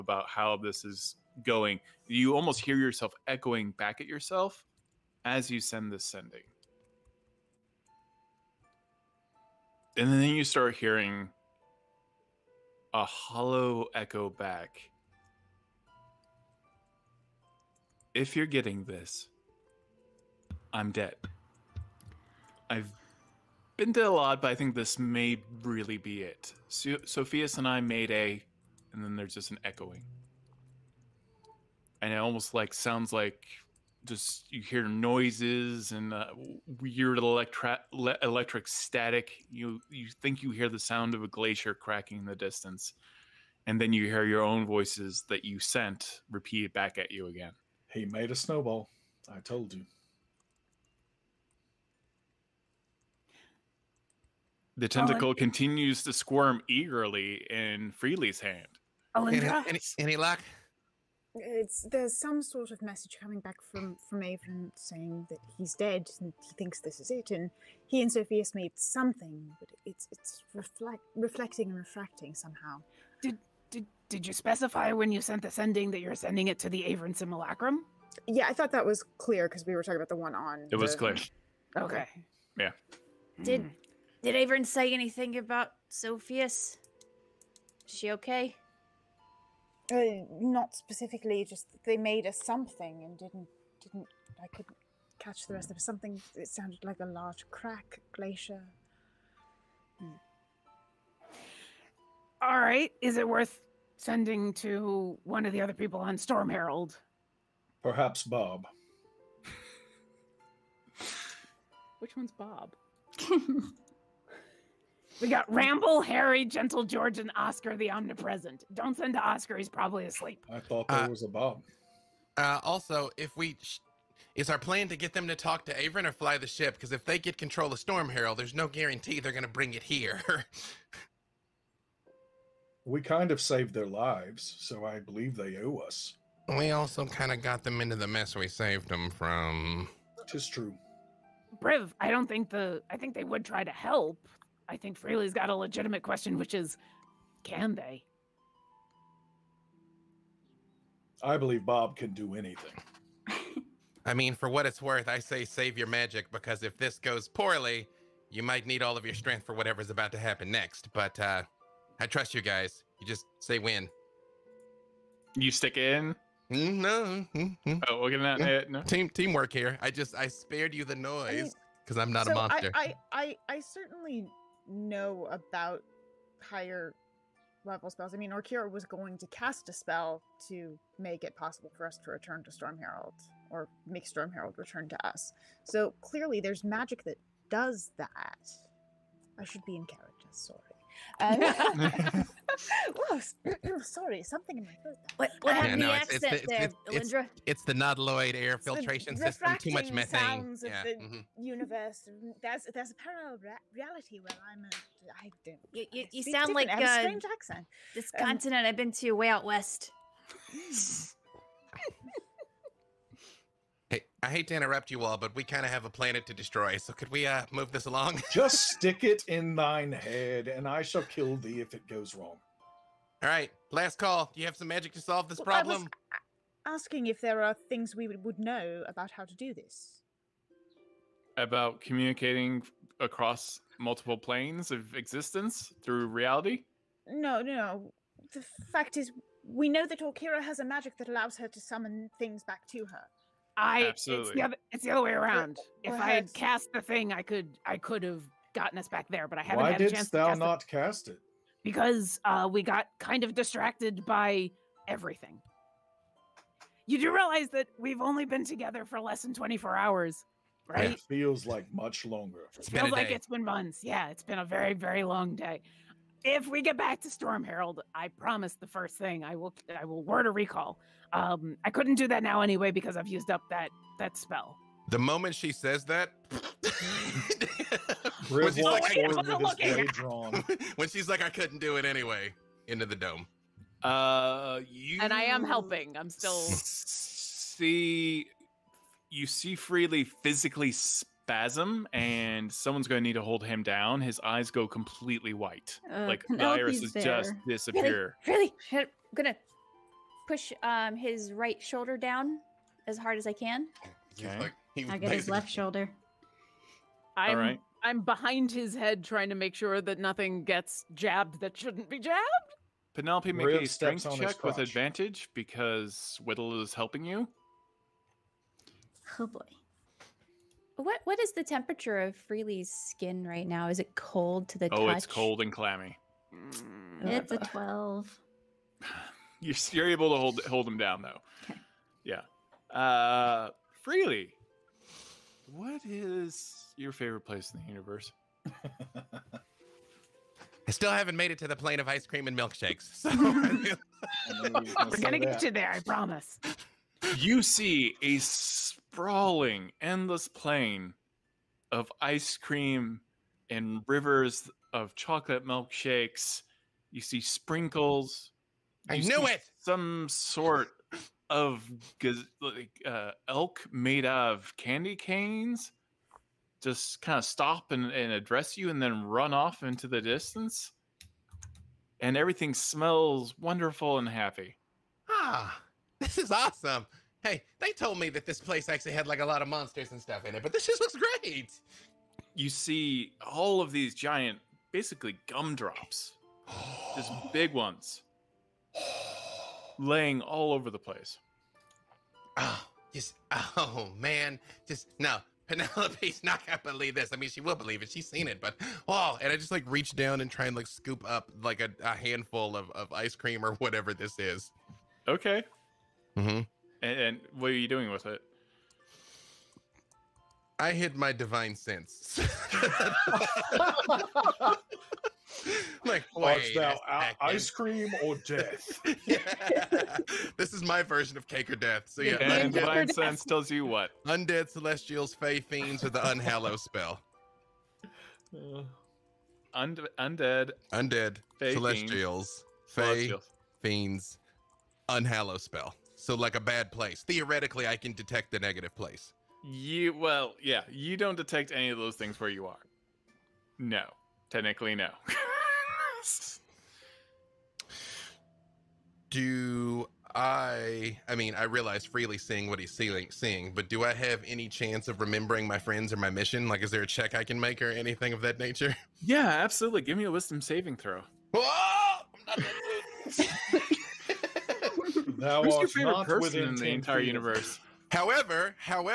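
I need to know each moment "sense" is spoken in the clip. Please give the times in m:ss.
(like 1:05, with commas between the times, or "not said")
6:51, 7:02.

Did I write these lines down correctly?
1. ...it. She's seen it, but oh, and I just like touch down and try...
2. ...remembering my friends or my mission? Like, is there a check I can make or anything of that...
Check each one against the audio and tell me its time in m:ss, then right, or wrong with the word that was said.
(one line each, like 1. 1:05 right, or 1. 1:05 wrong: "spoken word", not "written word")
1. 6:37 wrong: "reach", not "touch"
2. 7:35 right.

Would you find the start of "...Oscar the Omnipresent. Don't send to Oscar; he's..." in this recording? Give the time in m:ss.
1:57.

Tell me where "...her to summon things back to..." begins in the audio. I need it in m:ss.
4:01.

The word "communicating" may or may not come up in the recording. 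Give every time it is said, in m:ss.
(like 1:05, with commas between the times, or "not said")
3:51.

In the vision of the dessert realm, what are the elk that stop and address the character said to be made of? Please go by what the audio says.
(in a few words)
candy canes.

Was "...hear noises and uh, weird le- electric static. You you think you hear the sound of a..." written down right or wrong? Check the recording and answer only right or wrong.
right.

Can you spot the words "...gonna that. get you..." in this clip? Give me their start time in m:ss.
5:44.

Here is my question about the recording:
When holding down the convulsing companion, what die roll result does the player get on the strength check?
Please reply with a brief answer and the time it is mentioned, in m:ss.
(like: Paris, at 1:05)
12, at 5:27.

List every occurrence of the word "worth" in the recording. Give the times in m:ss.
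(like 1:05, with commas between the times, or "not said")
1:43, 2:34.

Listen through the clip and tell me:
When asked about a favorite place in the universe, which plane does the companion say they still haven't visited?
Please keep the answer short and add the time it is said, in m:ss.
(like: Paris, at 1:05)
plane of ice cream and milkshakes, at 5:41.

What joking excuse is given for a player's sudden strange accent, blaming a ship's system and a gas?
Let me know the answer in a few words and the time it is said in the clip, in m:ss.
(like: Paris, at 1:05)
too much methane, at 3:19.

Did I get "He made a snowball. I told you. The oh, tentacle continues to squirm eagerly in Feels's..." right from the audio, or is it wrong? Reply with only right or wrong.
wrong.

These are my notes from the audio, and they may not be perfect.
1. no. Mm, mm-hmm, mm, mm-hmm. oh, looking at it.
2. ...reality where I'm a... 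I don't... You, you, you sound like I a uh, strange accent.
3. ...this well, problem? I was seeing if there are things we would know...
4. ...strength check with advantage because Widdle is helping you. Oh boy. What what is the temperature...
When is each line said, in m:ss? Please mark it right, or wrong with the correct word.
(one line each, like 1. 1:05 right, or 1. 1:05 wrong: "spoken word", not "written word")
1. 2:46 right
2. 3:23 right
3. 3:45 wrong: "asking", not "seeing"
4. 5:13 right.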